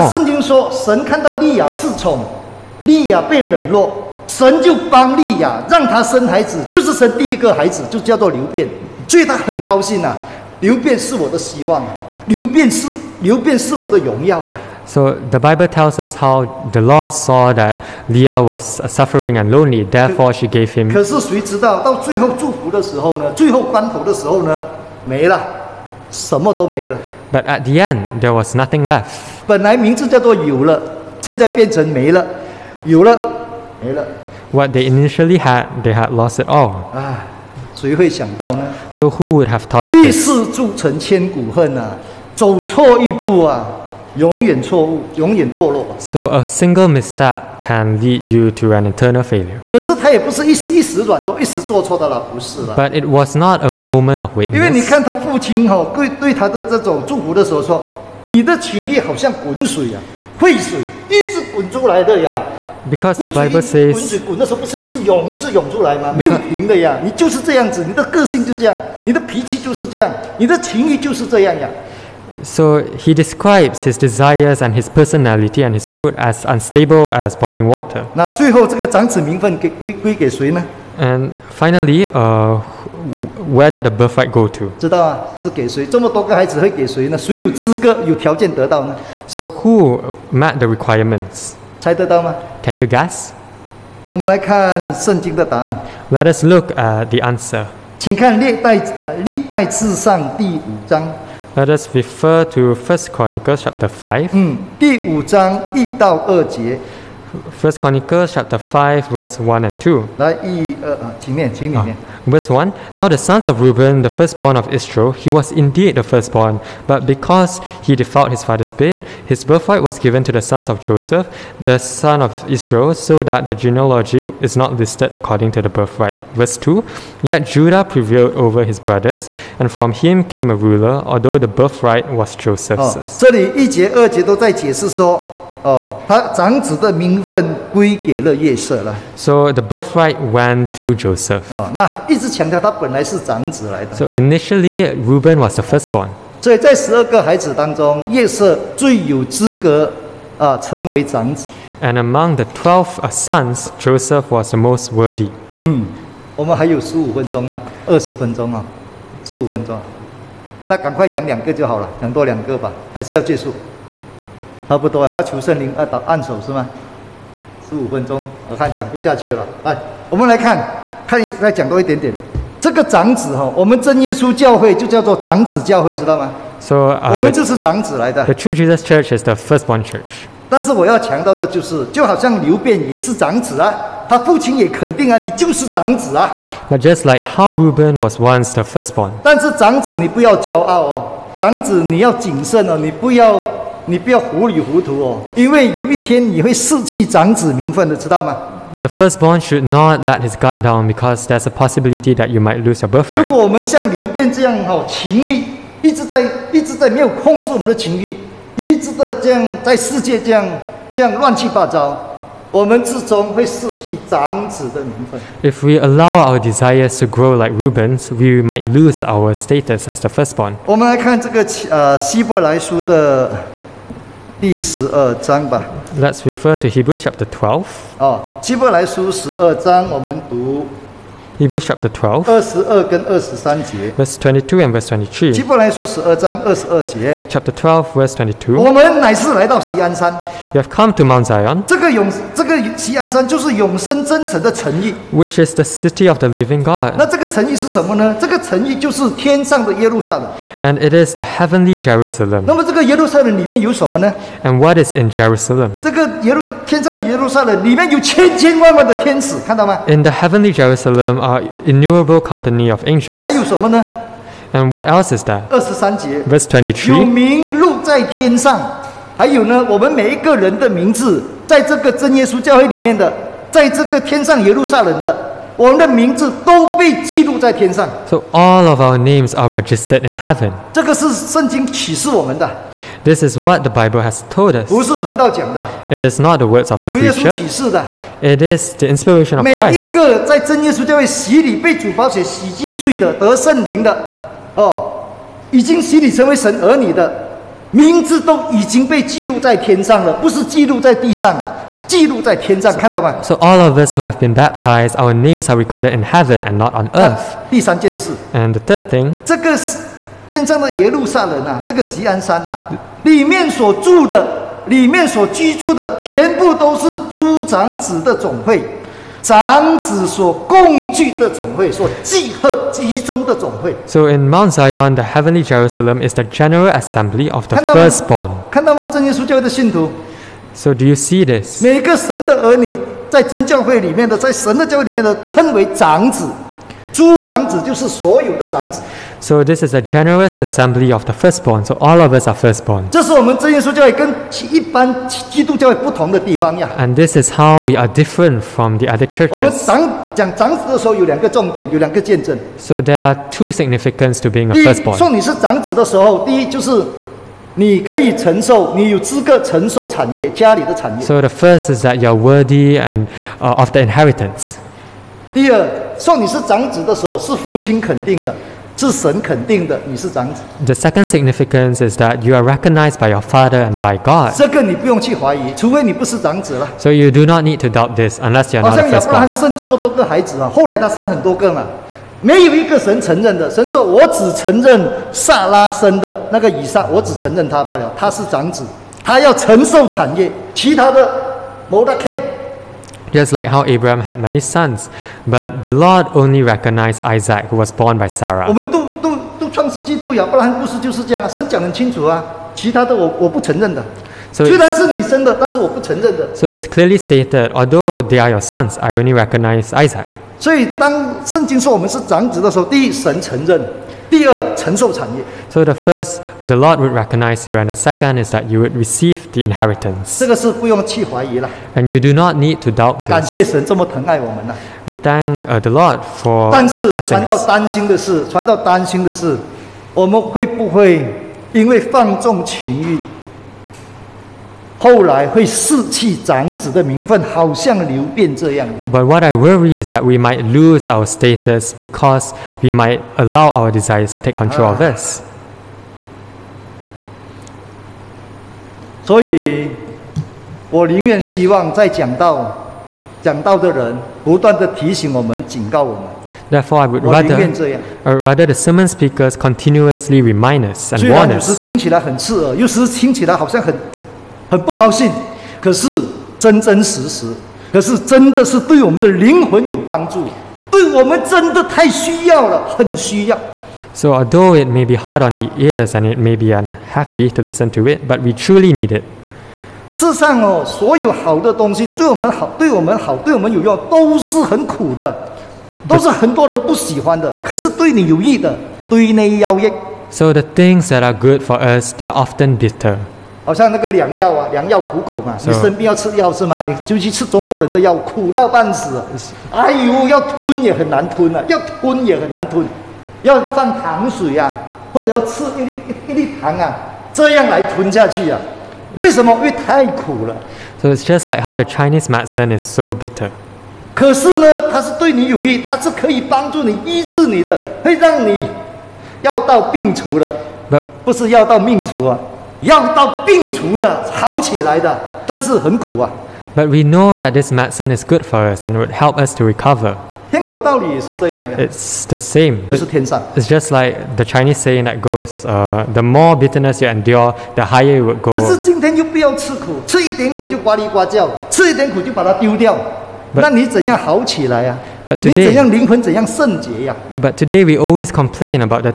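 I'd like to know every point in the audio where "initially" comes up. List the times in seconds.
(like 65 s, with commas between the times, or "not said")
34 s, 144 s.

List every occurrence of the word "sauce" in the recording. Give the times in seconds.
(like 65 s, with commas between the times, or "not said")
not said.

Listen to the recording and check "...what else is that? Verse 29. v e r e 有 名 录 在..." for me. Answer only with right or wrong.
wrong.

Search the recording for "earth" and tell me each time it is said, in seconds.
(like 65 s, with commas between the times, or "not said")
306 s.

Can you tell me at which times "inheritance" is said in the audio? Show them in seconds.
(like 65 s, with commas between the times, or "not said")
363 s, 419 s.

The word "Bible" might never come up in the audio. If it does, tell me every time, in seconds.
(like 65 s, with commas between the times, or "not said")
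15 s, 283 s.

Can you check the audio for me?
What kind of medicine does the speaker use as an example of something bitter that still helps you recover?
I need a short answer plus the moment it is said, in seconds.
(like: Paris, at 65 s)
Chinese medicine, at 511 s.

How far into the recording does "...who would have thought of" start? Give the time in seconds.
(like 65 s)
39 s.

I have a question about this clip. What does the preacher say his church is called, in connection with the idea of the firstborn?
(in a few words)
the firstborn church.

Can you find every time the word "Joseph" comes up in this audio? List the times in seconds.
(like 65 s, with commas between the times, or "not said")
120 s, 132 s, 140 s, 153 s.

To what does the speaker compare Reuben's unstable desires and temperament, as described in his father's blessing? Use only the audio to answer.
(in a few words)
boiling water.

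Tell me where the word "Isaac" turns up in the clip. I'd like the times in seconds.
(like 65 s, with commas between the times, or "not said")
397 s, 409 s.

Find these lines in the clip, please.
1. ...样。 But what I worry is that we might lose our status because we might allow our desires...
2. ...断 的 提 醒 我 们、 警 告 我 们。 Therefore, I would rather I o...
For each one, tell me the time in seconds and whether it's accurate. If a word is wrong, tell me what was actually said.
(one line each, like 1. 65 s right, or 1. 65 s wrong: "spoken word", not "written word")
1. 438 s right
2. 454 s right.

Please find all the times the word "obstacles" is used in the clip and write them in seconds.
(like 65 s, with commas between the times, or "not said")
not said.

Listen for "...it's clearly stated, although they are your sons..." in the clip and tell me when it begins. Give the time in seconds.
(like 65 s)
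406 s.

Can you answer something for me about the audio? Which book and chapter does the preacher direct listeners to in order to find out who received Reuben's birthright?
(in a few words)
First Chronicles chapter 5.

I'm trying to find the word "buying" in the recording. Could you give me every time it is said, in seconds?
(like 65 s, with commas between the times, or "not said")
not said.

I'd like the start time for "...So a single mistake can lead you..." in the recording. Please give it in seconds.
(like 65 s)
45 s.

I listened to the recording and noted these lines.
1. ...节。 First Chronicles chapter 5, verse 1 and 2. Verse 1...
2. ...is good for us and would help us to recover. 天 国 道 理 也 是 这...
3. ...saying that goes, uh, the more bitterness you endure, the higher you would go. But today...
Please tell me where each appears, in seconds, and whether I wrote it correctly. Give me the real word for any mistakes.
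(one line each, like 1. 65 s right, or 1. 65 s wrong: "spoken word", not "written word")
1. 106 s right
2. 527 s right
3. 534 s right.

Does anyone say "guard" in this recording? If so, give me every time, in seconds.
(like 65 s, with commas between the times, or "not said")
200 s.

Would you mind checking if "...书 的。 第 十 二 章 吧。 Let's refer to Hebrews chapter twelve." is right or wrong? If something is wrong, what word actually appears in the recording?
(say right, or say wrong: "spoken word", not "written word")
right.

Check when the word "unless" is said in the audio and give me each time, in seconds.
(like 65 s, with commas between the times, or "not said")
378 s.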